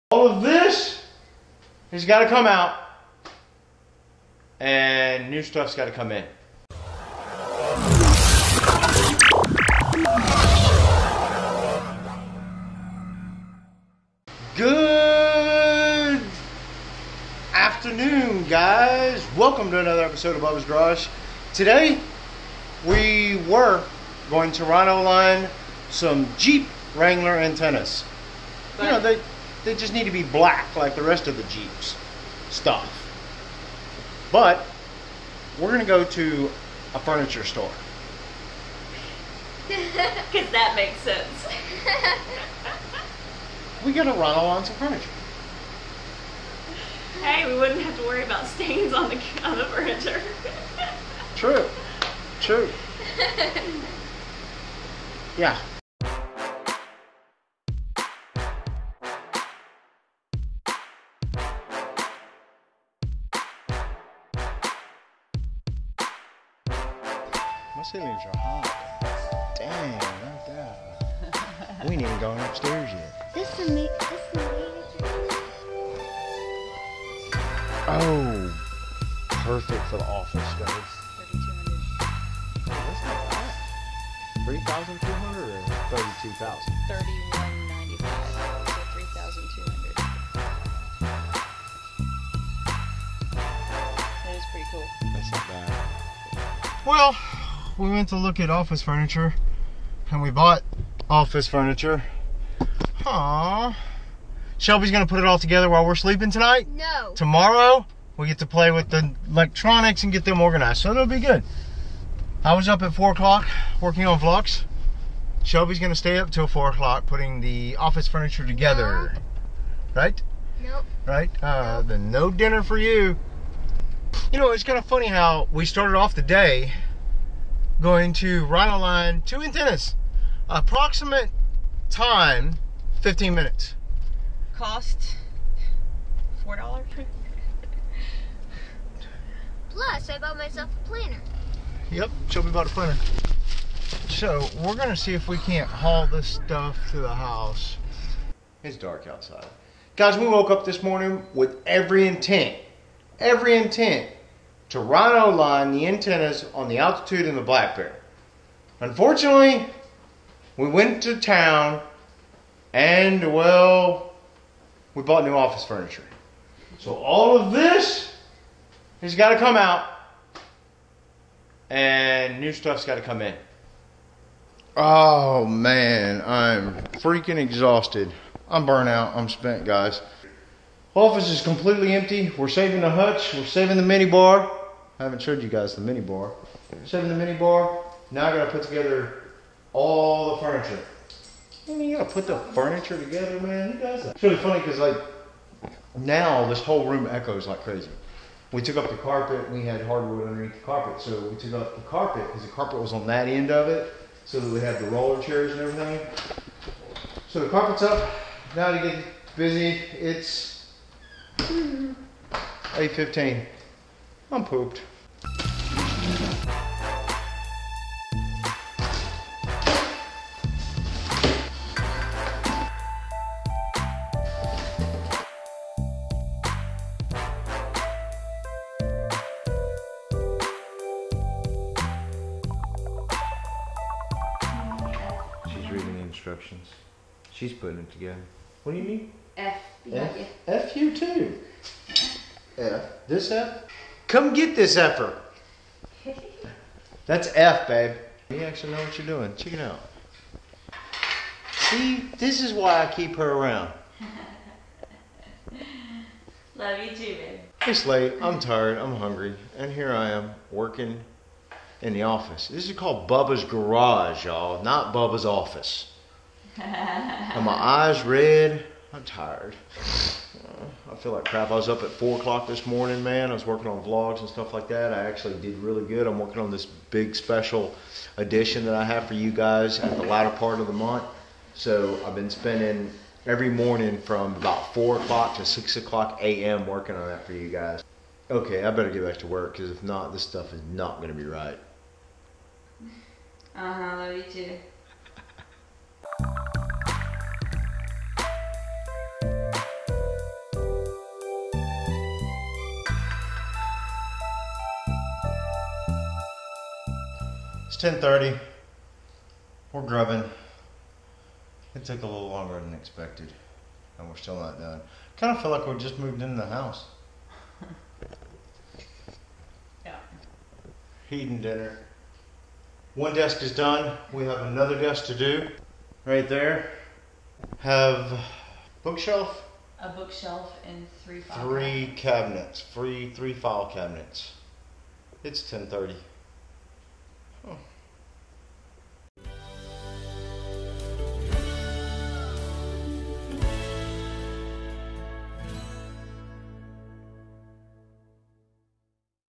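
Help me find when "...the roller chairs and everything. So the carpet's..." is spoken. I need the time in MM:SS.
03:24.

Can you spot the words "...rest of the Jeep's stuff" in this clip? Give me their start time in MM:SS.
00:31.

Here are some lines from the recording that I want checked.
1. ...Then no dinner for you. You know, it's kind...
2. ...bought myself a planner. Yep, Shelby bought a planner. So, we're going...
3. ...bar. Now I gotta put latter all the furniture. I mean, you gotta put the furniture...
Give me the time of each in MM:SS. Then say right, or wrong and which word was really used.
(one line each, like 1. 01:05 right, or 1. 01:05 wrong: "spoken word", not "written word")
1. 02:01 right
2. 02:20 right
3. 03:07 wrong: "together", not "latter".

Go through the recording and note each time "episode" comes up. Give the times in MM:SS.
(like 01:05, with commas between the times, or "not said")
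00:20.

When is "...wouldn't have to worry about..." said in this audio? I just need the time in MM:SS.
00:47.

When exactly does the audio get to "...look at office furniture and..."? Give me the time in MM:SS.
01:38.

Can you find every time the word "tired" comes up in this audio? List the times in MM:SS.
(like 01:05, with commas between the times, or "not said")
04:18, 04:29.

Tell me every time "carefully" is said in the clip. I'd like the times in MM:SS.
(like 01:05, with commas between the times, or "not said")
not said.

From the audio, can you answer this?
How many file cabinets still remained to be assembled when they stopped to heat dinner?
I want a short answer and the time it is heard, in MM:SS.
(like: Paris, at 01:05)
3, at 05:33.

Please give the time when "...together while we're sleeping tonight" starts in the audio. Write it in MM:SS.
01:45.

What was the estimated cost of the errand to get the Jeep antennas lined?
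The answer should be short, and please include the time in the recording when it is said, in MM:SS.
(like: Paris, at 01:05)
$4, at 02:14.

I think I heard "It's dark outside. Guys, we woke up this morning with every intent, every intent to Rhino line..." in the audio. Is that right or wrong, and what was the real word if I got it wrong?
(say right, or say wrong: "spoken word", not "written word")
right.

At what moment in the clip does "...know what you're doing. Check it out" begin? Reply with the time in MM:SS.
04:08.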